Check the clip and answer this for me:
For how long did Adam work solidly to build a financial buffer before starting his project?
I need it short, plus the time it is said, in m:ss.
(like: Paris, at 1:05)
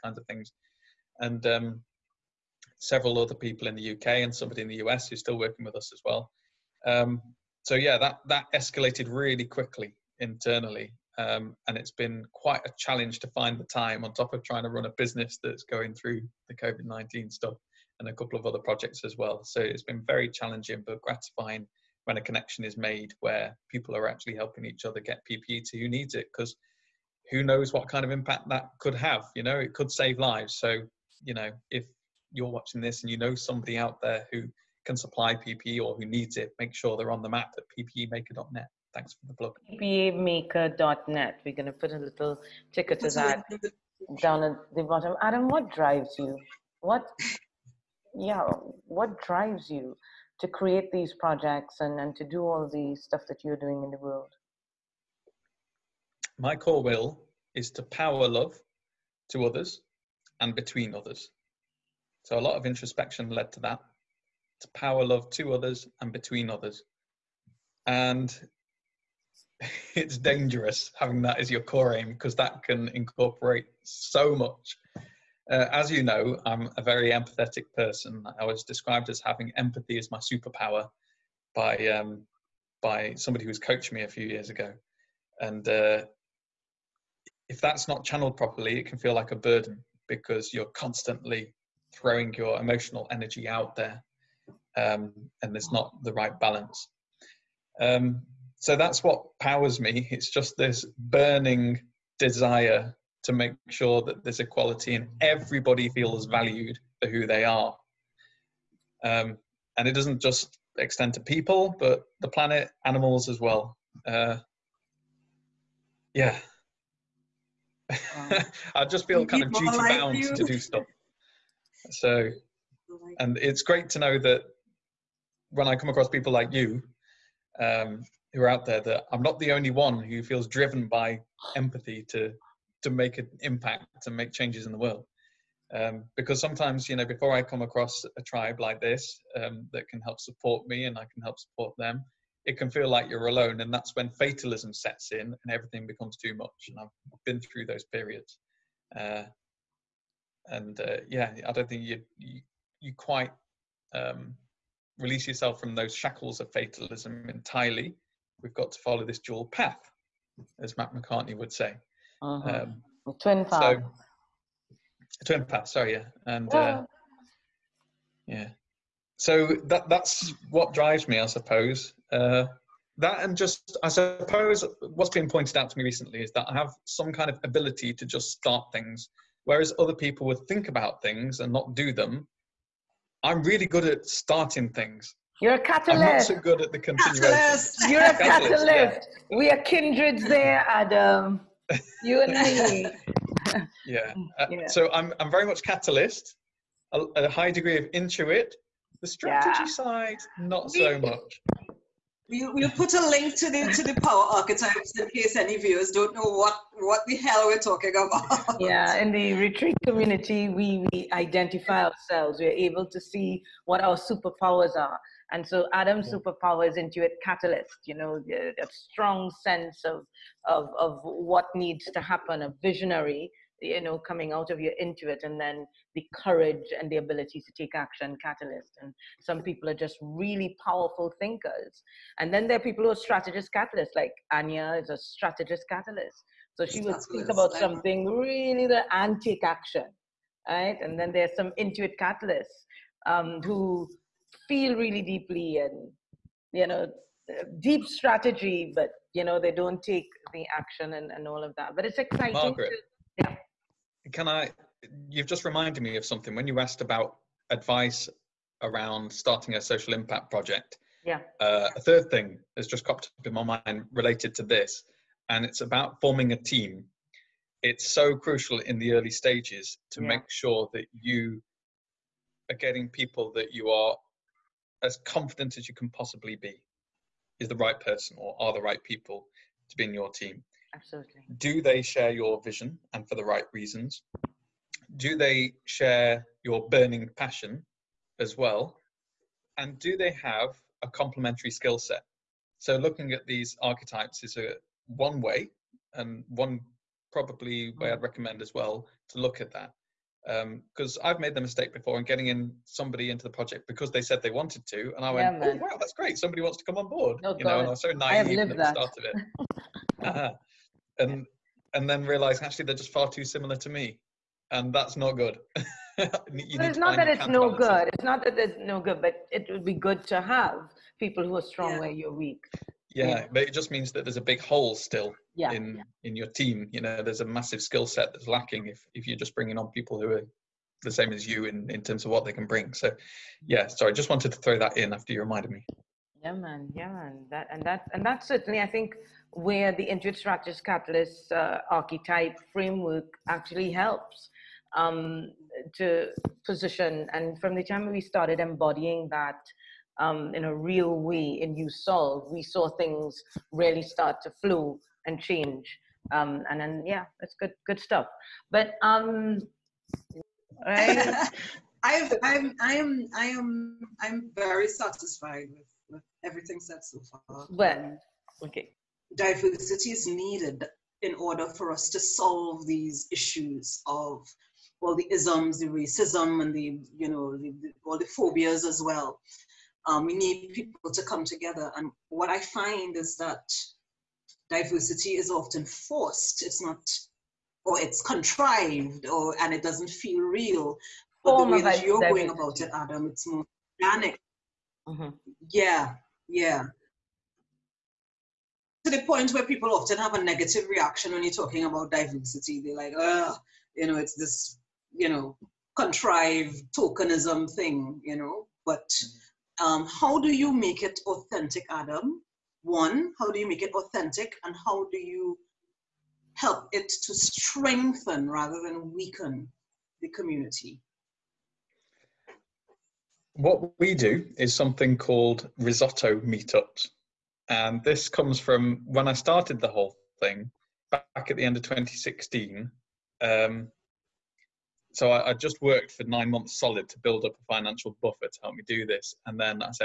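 9 months, at 7:16.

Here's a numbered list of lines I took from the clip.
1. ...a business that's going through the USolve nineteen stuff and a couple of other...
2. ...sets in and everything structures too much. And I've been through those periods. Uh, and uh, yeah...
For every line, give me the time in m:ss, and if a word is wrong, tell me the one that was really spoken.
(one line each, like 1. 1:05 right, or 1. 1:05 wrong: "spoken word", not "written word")
1. 0:14 wrong: "COVID", not "USolve"
2. 2:24 wrong: "becomes", not "structures".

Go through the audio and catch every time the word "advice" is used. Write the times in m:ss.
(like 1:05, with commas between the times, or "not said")
4:17.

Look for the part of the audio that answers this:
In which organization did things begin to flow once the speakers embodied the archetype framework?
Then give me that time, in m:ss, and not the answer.
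5:51.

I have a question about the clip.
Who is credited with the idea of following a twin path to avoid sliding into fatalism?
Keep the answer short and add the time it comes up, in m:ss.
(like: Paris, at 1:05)
Matt McCartney, at 2:40.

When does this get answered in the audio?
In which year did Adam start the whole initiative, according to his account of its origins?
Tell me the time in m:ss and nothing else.
7:11.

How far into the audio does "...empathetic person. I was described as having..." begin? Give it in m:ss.
1:17.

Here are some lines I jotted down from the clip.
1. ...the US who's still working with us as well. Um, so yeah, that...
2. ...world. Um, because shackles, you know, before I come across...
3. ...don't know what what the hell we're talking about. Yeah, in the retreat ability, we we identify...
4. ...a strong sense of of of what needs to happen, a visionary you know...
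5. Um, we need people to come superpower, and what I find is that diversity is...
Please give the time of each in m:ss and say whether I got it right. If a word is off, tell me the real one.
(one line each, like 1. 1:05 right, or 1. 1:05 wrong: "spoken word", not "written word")
1. 0:04 right
2. 2:14 wrong: "sometimes", not "shackles"
3. 3:25 wrong: "community", not "ability"
4. 3:38 right
5. 6:19 wrong: "together", not "superpower".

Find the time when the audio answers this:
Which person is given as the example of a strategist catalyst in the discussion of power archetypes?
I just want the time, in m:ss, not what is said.
3:54.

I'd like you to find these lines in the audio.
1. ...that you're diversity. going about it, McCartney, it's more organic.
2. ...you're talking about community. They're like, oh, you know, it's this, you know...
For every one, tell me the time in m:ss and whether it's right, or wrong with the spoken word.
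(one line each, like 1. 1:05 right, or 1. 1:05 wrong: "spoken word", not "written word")
1. 6:31 wrong: "Adam", not "McCartney"
2. 6:41 wrong: "diversity", not "community".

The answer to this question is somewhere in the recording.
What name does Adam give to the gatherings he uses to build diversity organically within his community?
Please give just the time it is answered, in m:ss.
7:05.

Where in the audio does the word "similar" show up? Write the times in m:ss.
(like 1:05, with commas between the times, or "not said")
5:13.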